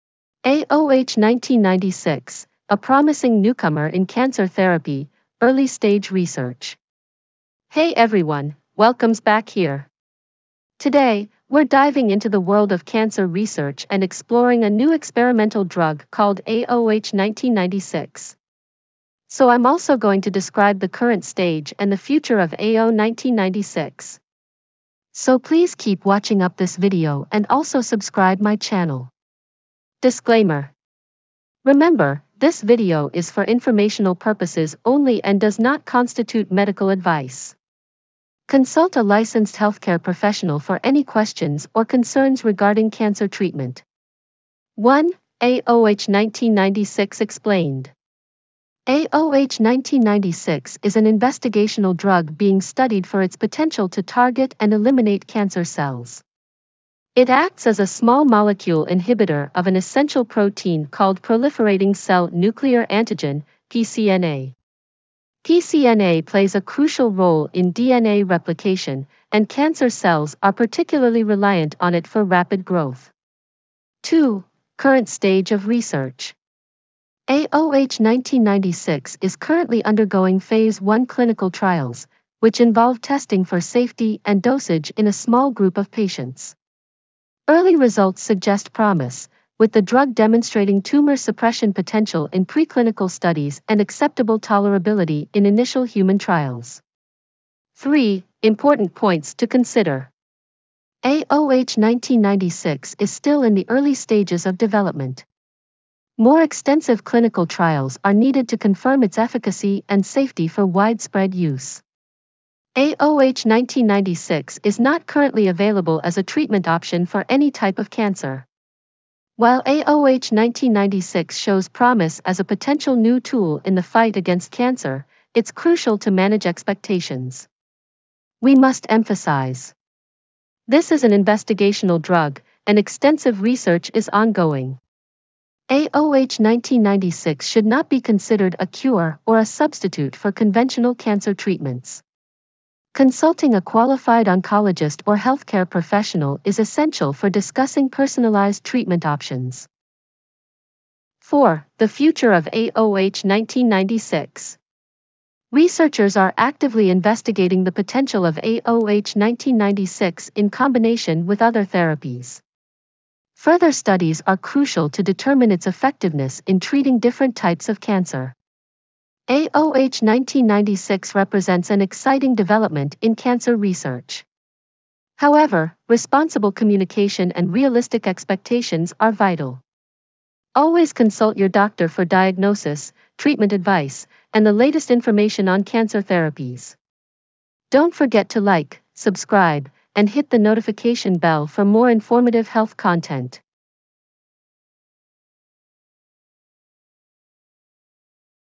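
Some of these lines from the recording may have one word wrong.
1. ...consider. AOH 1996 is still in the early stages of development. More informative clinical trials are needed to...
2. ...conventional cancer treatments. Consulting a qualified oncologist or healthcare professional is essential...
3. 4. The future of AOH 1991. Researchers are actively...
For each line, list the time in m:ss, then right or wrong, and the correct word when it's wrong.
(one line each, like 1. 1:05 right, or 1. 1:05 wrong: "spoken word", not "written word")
1. 1:39 wrong: "extensive", not "informative"
2. 2:20 right
3. 2:31 wrong: "1996", not "1991".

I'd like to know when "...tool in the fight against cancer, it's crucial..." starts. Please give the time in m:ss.
2:03.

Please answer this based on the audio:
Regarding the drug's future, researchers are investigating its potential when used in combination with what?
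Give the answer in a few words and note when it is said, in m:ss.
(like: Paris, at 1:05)
Other therapies, at 2:41.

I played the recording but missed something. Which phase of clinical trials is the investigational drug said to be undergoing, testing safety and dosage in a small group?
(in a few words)
Phase 1.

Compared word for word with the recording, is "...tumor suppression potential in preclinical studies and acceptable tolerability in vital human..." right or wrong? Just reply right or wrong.
wrong.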